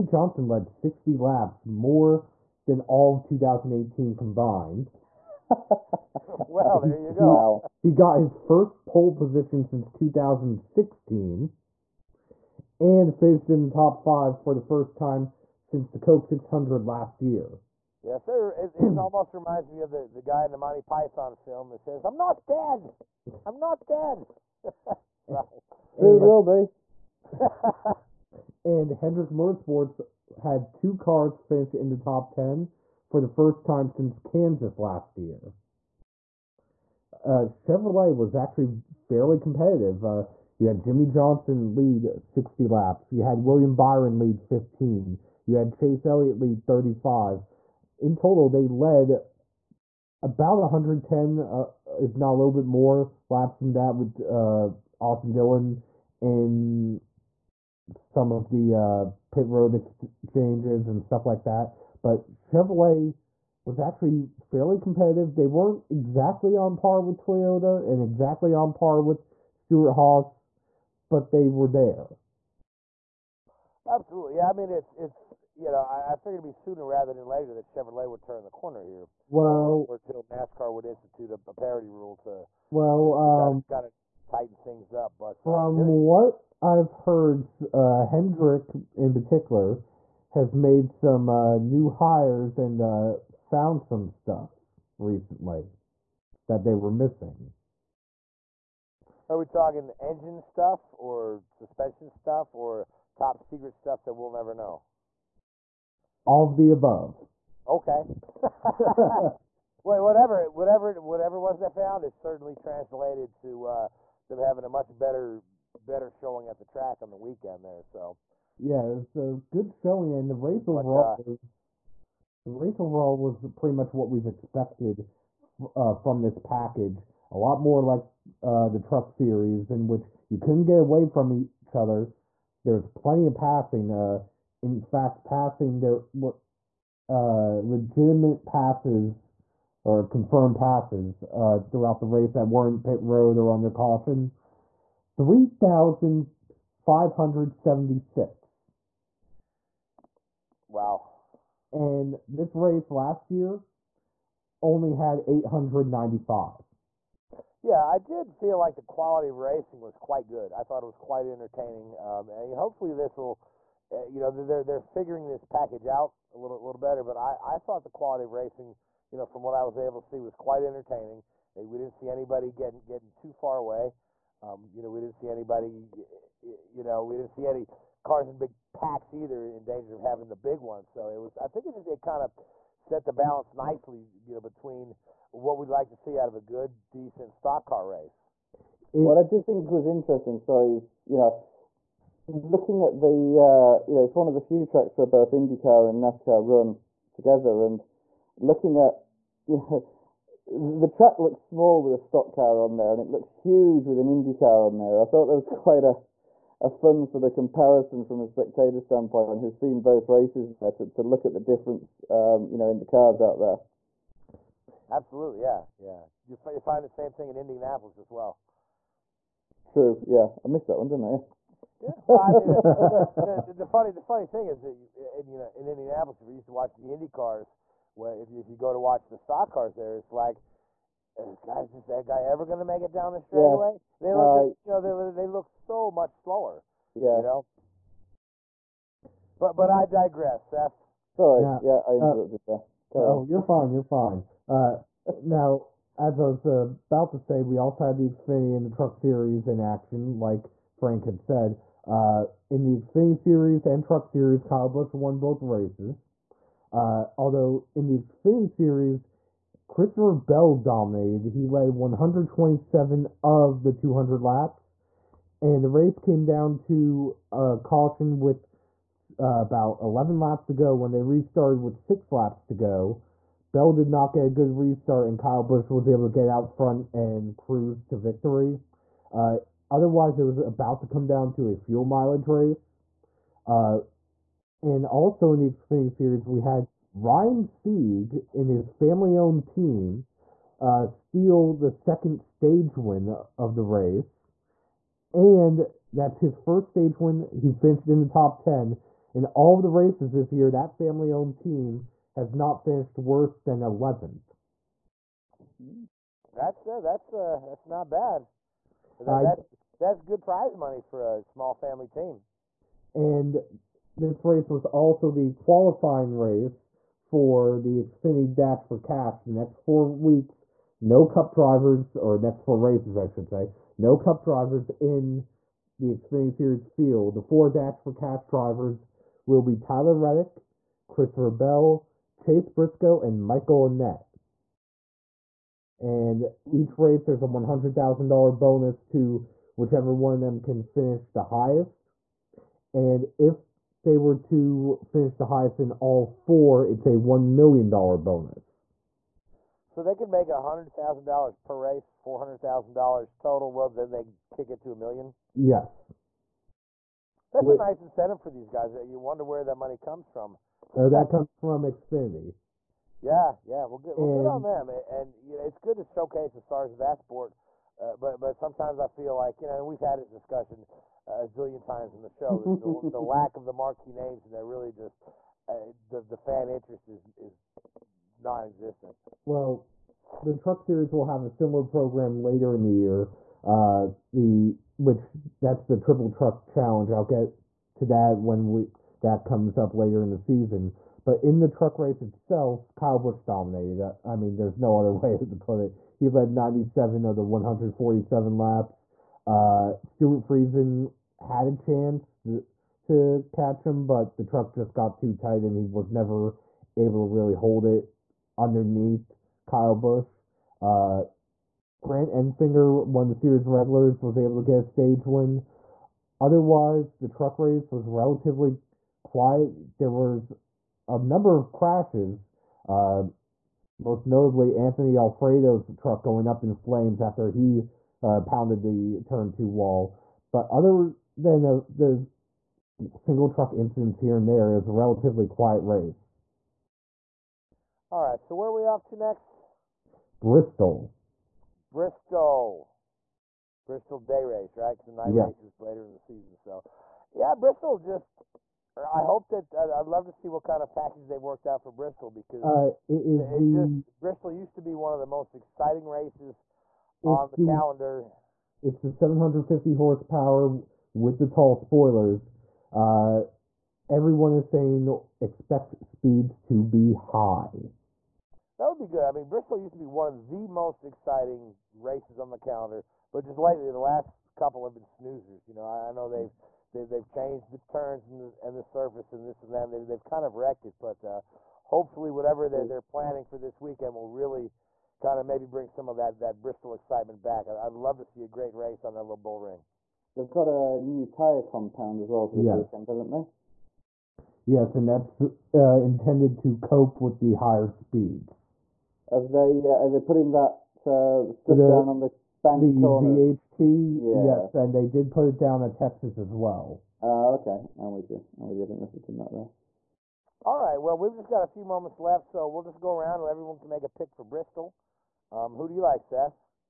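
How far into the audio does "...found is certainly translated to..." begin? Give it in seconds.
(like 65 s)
111 s.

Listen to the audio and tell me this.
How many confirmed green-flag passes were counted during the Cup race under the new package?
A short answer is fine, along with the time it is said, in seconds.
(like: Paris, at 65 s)
3576, at 145 s.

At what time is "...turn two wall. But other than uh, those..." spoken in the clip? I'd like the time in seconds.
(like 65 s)
429 s.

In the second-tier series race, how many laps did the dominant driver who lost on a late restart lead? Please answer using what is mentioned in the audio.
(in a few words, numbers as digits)
127.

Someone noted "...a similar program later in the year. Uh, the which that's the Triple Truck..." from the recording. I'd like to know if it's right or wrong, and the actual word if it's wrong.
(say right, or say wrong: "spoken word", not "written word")
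right.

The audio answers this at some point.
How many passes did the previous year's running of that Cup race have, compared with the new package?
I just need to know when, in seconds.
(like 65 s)
155 s.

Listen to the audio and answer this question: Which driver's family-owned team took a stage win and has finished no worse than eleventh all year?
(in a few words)
Ryan Sieg.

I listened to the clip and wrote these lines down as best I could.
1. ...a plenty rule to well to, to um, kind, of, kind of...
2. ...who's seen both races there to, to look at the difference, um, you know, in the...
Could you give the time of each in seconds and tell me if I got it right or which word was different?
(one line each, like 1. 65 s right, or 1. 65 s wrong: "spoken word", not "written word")
1. 81 s wrong: "parity", not "plenty"
2. 209 s right.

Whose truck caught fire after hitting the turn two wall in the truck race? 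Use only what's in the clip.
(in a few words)
Anthony Alfredo.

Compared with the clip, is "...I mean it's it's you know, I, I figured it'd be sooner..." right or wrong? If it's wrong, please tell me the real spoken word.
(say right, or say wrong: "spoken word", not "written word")
right.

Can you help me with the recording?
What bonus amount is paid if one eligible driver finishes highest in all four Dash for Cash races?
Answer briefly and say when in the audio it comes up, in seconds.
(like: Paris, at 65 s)
$1,000,000, at 346 s.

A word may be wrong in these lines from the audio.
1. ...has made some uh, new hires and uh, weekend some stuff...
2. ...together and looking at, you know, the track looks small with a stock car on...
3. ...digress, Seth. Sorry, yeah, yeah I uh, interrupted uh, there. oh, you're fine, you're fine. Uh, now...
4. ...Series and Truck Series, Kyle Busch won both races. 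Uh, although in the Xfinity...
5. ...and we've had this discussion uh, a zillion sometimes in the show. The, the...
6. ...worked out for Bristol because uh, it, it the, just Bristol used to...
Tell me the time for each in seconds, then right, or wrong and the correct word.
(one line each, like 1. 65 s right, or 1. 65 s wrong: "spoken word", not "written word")
1. 90 s wrong: "found", not "weekend"
2. 197 s right
3. 239 s right
4. 253 s right
5. 369 s wrong: "times", not "sometimes"
6. 451 s right.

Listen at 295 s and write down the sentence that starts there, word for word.
And that's his first stage win.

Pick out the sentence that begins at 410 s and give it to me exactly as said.
Uh, Grant Enfinger won the series regulars, was able to get a stage win.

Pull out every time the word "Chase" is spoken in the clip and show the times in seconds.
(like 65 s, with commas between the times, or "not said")
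45 s, 332 s.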